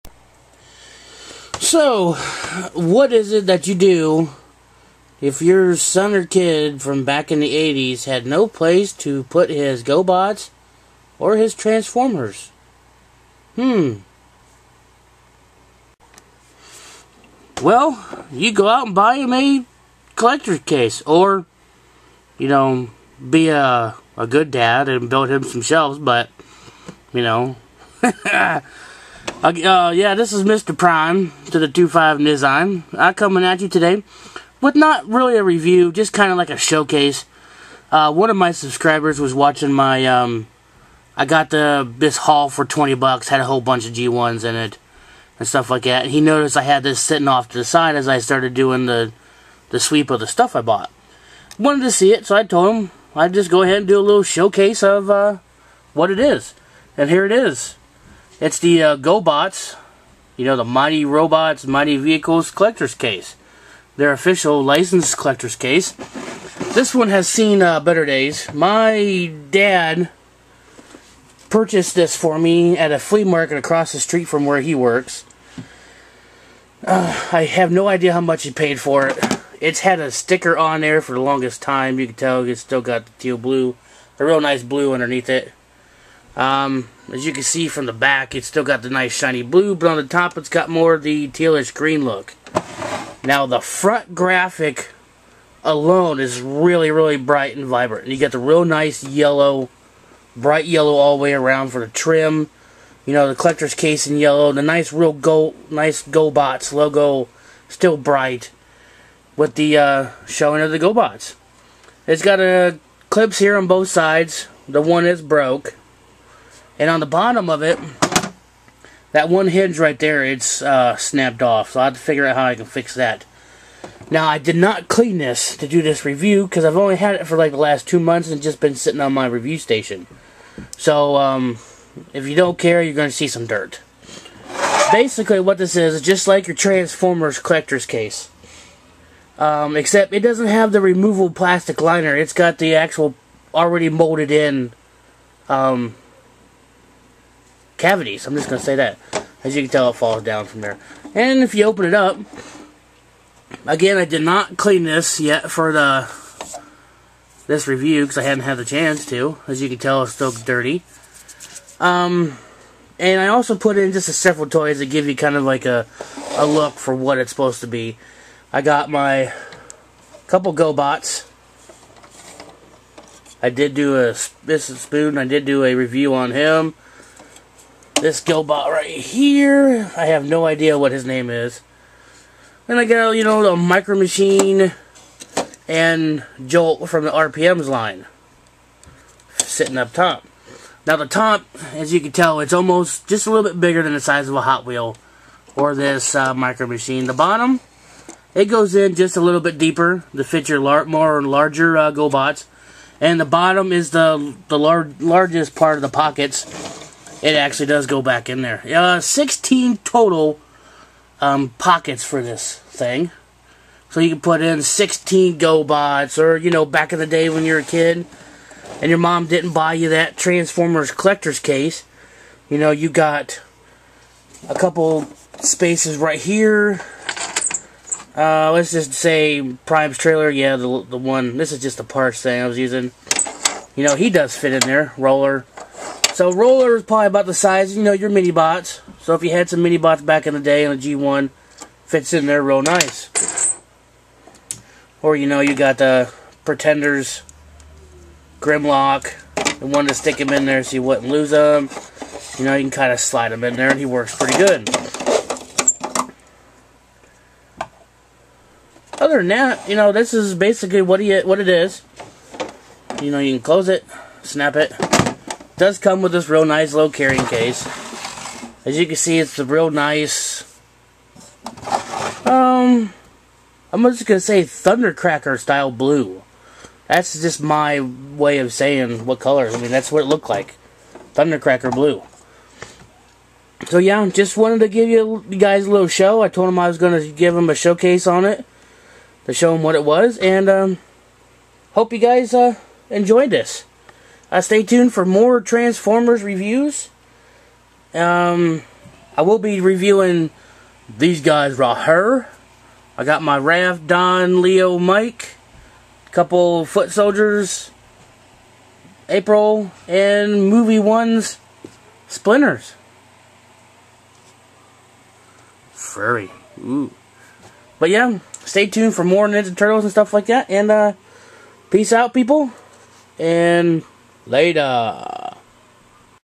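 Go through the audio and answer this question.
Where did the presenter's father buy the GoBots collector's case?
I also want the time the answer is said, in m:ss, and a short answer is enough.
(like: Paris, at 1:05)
A flea market, at 1:12.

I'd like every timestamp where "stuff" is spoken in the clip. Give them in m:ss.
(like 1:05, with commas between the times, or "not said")
0:45, 0:50, 5:19.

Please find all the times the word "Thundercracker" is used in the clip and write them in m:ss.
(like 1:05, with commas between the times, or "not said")
4:34, 4:41.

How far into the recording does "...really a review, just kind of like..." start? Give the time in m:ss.
0:35.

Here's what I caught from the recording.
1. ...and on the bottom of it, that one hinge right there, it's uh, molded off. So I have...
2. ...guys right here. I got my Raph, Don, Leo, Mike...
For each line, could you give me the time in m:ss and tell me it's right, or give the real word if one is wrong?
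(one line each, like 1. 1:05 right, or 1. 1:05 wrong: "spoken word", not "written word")
1. 1:56 wrong: "snapped", not "molded"
2. 5:01 right.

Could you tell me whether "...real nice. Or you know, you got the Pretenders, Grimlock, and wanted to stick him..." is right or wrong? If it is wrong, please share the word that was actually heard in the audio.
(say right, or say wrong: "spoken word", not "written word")
right.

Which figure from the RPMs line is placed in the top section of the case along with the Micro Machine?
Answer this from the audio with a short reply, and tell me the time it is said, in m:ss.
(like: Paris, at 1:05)
Jolt, at 3:06.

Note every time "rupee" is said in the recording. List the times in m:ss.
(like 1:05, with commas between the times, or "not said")
not said.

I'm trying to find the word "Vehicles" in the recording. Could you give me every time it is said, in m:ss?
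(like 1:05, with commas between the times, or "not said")
1:01.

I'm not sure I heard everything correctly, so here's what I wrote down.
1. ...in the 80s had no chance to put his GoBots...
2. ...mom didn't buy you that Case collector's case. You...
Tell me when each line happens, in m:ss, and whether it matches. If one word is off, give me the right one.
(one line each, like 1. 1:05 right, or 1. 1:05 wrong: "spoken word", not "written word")
1. 0:07 wrong: "place", not "chance"
2. 3:38 wrong: "Transformers", not "Case".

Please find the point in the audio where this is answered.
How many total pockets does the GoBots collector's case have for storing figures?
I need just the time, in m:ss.
3:28.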